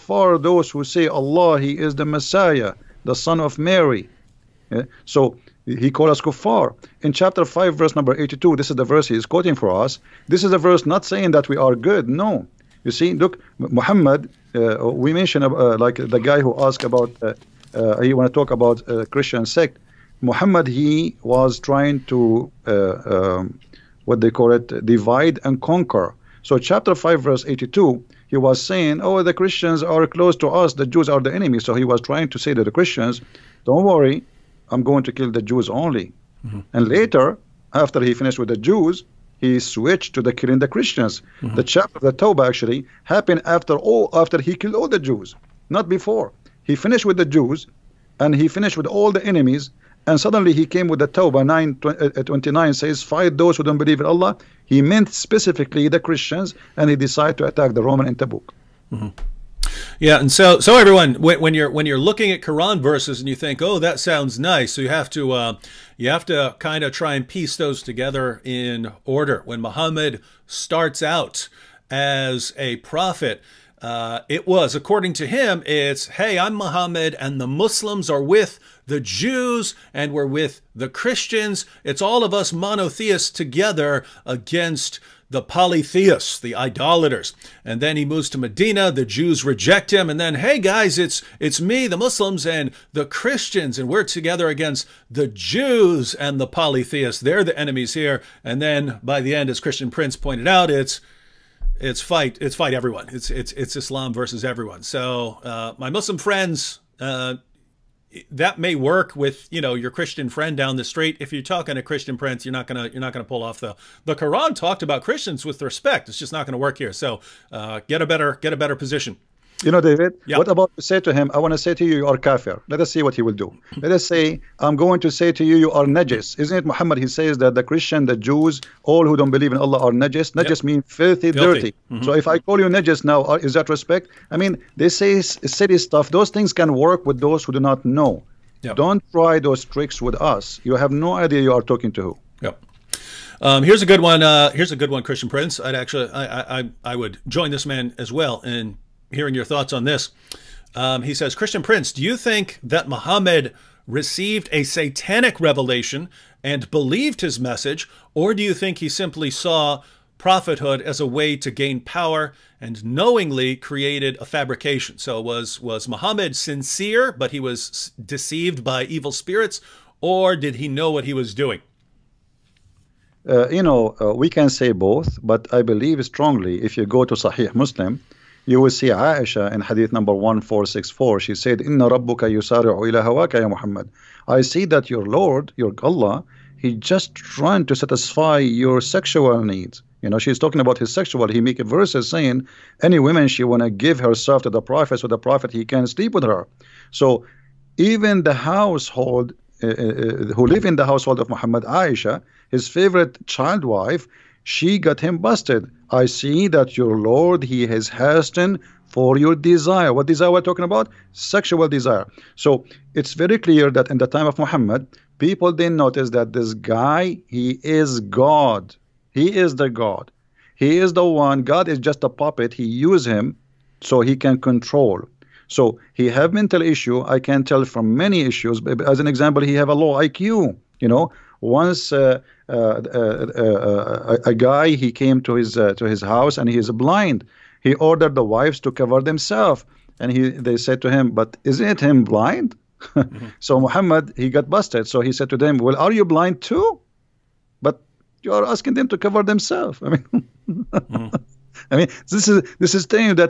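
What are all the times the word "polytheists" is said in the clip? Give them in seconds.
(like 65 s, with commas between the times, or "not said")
85 s, 96 s.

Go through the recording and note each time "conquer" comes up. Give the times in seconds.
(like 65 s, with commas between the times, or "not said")
25 s.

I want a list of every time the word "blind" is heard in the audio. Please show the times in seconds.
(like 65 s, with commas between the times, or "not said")
236 s, 242 s, 246 s.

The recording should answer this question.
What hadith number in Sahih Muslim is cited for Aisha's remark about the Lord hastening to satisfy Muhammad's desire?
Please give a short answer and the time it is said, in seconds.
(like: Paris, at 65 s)
1464, at 180 s.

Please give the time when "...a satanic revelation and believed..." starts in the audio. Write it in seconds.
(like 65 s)
154 s.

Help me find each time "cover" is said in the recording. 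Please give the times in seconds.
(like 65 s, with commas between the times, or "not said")
238 s, 248 s.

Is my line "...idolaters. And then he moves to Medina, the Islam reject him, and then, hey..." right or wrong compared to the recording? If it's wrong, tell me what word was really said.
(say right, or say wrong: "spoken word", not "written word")
wrong: "Jews", not "Islam".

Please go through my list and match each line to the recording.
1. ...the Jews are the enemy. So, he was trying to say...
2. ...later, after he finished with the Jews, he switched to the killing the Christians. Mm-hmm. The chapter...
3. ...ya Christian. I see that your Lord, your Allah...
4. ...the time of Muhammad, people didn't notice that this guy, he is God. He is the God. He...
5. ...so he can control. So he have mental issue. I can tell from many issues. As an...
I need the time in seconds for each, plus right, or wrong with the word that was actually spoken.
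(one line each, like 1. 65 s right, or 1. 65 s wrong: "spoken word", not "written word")
1. 30 s right
2. 36 s right
3. 183 s wrong: "Muhammad", not "Christian"
4. 213 s right
5. 223 s right.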